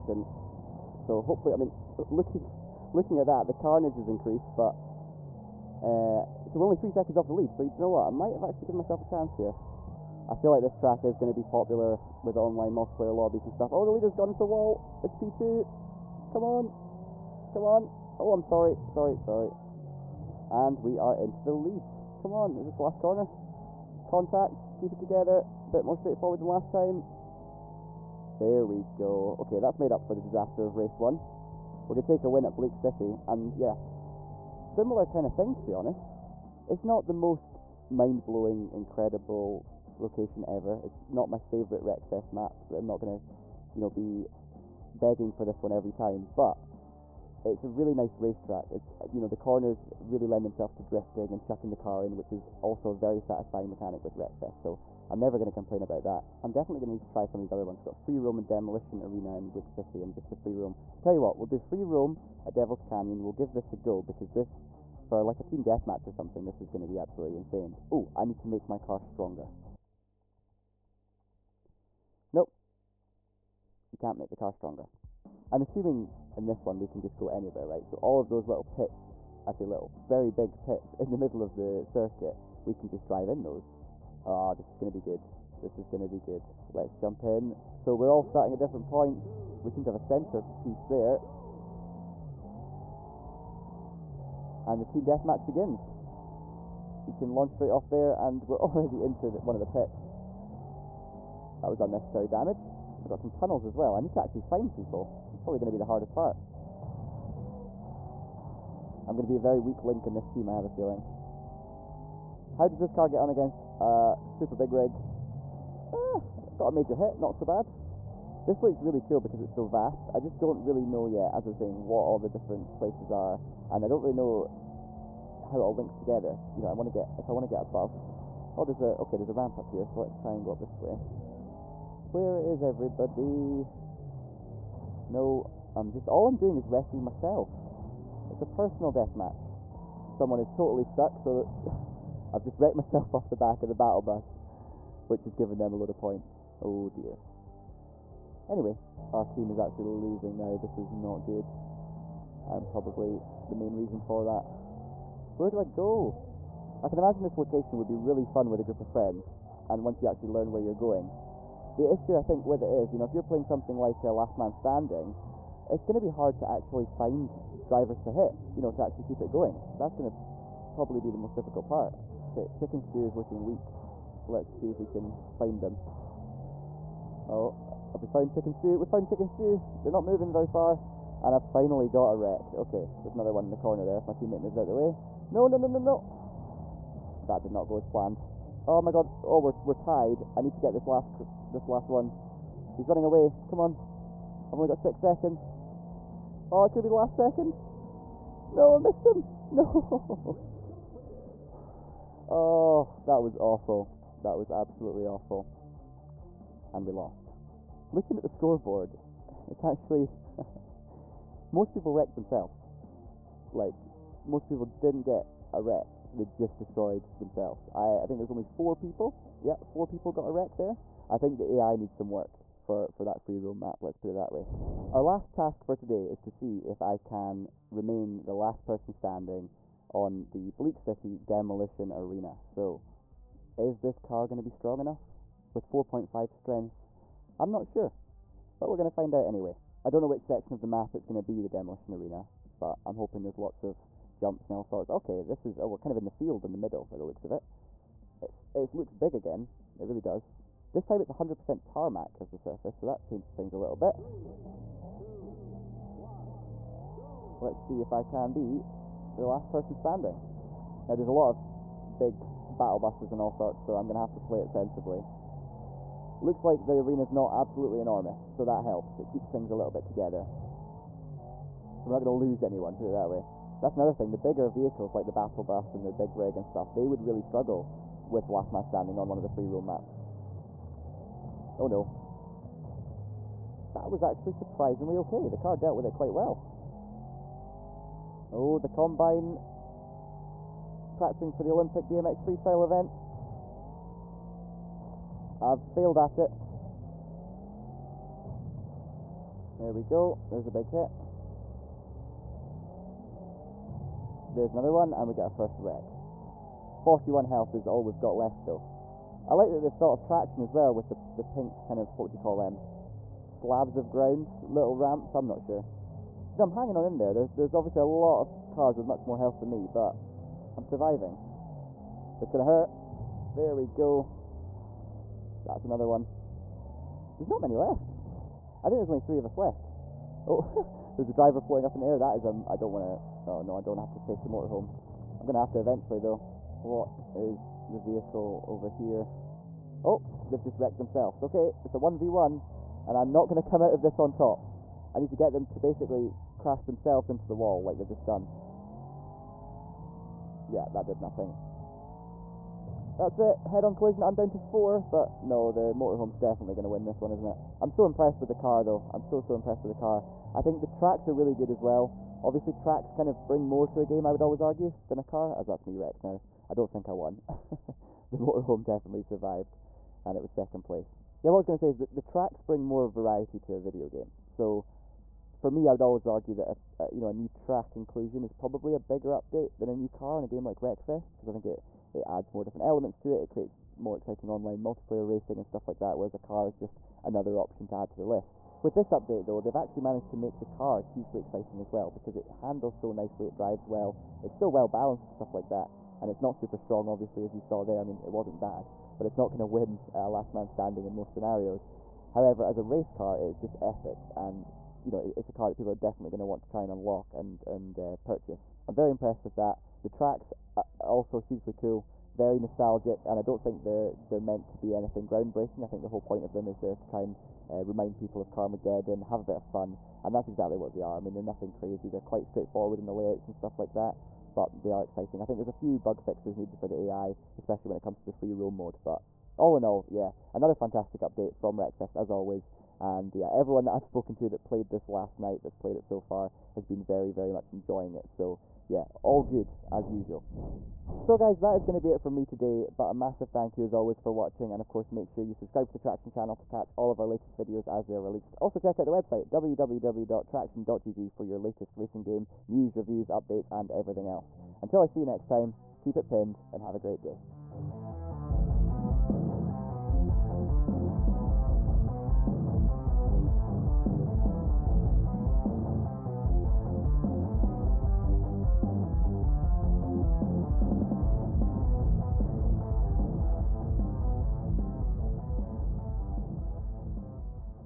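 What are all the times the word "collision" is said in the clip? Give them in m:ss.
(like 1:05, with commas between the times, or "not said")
5:53.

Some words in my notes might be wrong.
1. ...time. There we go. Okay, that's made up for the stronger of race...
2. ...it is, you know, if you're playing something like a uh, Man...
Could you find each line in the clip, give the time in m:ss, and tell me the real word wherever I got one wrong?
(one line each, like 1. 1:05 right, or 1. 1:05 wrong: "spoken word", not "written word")
1. 0:26 wrong: "disaster", not "stronger"
2. 2:42 wrong: "Last", not "Man".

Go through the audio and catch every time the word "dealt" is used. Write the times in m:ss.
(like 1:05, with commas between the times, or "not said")
4:45.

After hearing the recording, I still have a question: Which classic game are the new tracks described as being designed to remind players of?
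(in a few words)
Carmageddon.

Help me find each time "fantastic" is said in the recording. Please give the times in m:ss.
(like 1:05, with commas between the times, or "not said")
7:10.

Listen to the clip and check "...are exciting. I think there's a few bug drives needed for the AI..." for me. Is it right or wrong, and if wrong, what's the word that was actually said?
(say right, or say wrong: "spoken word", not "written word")
wrong: "fixes", not "drives".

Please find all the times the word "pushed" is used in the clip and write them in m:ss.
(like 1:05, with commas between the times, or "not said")
not said.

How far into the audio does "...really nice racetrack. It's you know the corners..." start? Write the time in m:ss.
0:47.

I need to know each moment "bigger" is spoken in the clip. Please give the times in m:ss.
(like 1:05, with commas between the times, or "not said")
4:34, 6:18.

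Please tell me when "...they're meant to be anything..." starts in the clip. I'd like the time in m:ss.
6:54.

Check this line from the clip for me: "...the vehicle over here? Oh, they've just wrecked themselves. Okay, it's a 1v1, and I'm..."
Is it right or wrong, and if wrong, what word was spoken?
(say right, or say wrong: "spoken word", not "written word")
right.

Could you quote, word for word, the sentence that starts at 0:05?
Uh, so we're only three seconds off the lead, so you know what?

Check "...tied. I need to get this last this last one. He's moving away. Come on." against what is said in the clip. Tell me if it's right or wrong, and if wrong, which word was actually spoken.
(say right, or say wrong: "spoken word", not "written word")
wrong: "running", not "moving".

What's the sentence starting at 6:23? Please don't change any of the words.
It creates more exciting online multiplayer racing and stuff like that.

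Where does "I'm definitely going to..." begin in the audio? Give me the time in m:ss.
0:56.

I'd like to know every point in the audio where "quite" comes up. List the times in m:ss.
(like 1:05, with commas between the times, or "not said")
4:45, 7:02.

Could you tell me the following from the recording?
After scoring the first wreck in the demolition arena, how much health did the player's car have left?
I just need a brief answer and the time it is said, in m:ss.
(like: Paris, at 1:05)
41, at 5:06.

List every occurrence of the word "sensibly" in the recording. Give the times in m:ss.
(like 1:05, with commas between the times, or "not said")
4:24.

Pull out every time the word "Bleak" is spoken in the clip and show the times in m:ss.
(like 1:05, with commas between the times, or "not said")
0:32, 0:59, 3:50.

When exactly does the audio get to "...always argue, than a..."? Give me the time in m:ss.
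6:04.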